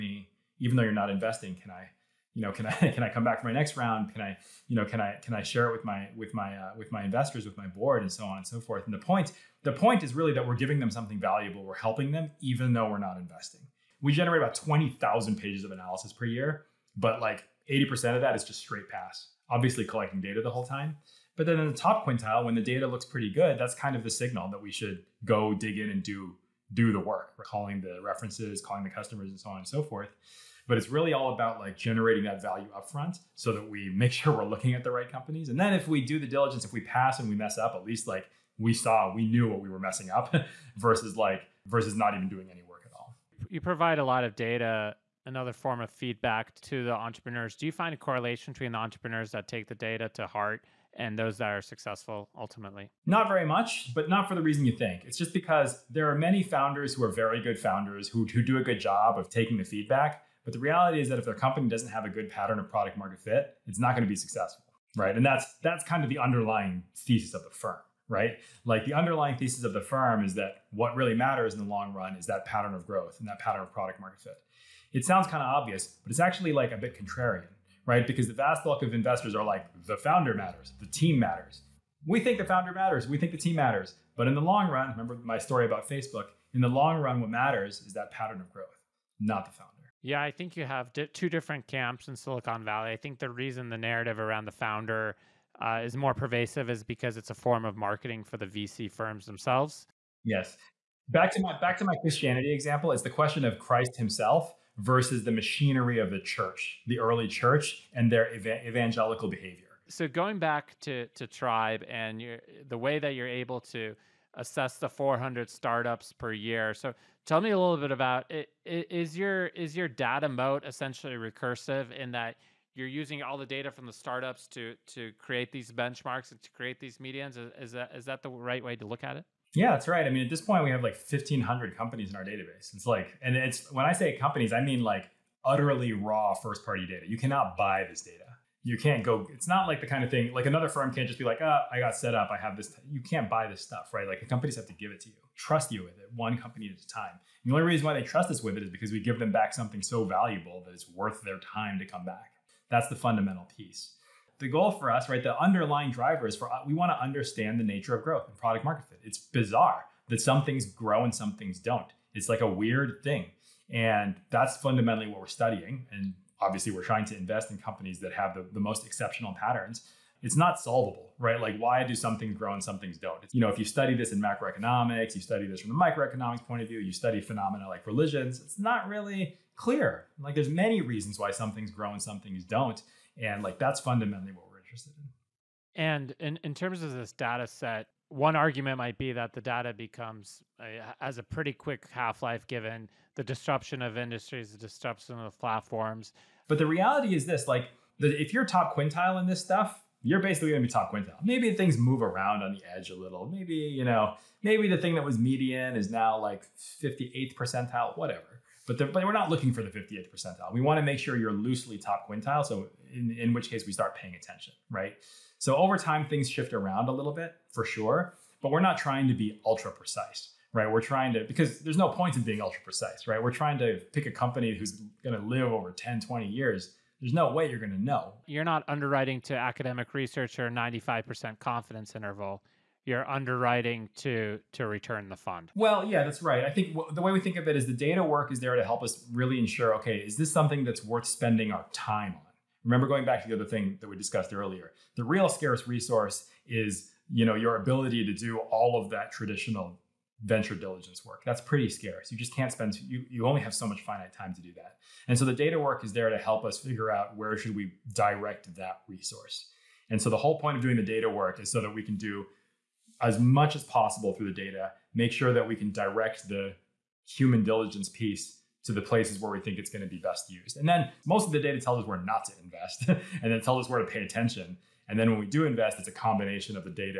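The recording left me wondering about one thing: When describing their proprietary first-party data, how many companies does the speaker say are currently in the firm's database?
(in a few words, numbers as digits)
1,500.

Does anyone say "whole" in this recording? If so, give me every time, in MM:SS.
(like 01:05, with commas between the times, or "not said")
00:20, 04:20.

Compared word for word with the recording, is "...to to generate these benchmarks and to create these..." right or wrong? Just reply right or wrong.
wrong.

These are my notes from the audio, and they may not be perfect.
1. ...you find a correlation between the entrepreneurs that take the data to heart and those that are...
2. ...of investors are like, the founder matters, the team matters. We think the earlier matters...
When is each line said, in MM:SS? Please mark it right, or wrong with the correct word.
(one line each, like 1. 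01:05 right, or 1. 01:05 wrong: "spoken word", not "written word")
1. 00:47 right
2. 01:18 wrong: "founder", not "earlier".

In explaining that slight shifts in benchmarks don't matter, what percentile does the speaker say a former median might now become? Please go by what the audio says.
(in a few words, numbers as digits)
58th percentile.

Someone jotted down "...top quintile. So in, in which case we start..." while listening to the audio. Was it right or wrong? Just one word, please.
right.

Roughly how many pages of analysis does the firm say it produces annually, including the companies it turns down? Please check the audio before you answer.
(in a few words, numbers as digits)
20,000.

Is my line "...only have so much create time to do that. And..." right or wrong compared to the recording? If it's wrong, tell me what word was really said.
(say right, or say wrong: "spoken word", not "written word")
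wrong: "finite", not "create".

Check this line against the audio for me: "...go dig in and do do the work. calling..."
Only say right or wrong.
right.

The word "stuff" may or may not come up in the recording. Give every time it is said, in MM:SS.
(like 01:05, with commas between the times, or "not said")
02:23, 03:19.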